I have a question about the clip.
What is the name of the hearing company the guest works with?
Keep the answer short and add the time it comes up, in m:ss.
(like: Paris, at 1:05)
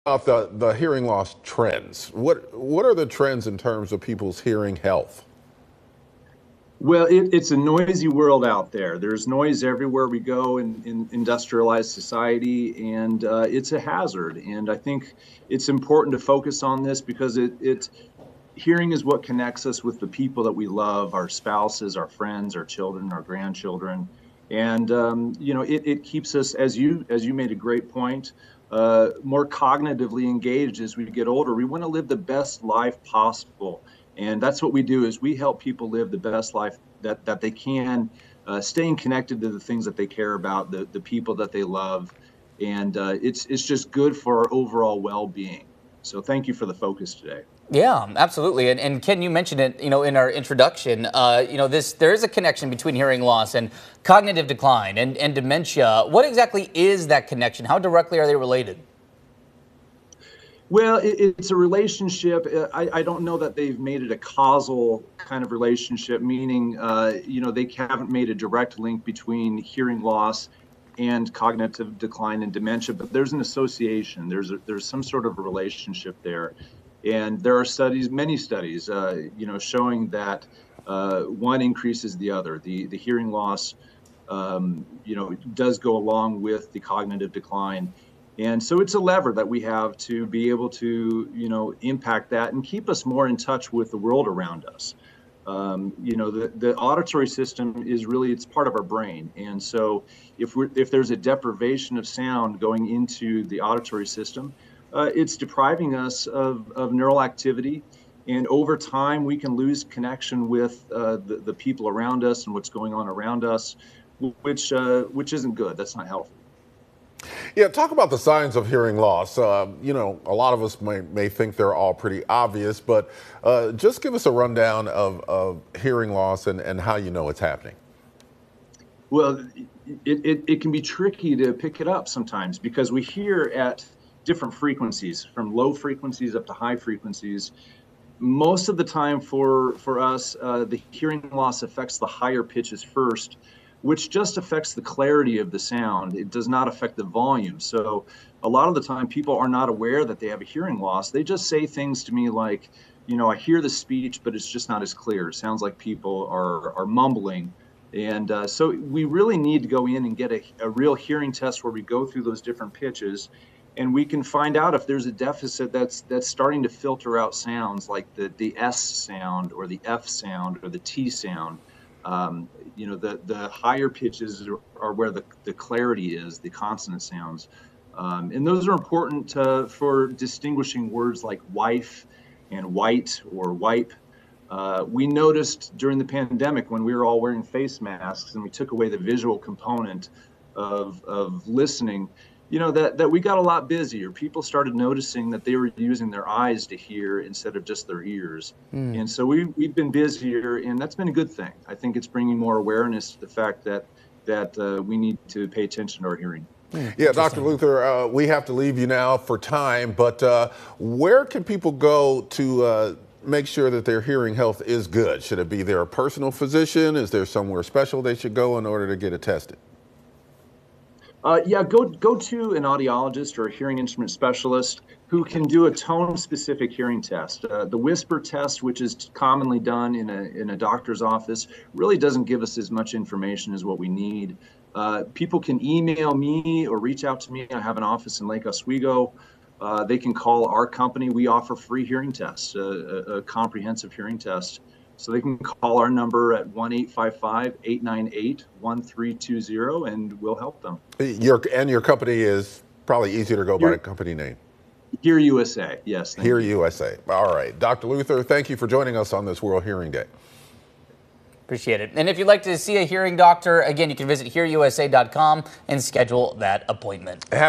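HearUSA, at 4:15.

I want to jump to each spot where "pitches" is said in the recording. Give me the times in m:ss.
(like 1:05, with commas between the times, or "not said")
2:22, 2:42, 2:53.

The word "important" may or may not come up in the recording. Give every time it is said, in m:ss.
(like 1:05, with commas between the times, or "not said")
0:15, 2:58.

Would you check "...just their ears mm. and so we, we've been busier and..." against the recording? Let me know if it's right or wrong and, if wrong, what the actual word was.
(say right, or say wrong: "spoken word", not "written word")
right.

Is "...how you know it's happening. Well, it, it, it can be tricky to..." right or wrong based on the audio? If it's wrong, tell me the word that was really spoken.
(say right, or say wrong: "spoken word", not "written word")
right.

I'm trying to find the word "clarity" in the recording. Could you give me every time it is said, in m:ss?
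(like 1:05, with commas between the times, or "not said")
2:24, 2:55.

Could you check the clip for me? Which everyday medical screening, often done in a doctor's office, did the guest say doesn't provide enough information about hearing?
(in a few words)
Whisper test.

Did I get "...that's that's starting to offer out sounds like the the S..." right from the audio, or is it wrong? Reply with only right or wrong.
wrong.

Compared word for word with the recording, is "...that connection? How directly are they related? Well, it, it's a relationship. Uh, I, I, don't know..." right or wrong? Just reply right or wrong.
right.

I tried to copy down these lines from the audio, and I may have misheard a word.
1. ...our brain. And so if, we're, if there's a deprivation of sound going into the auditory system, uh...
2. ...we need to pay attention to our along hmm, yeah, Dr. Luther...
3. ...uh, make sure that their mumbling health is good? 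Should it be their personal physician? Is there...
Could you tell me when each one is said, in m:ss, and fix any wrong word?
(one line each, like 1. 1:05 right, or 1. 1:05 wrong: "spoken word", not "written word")
1. 1:38 right
2. 3:24 wrong: "hearing", not "along"
3. 3:32 wrong: "hearing", not "mumbling".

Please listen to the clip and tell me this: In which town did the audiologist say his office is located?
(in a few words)
Lake Oswego.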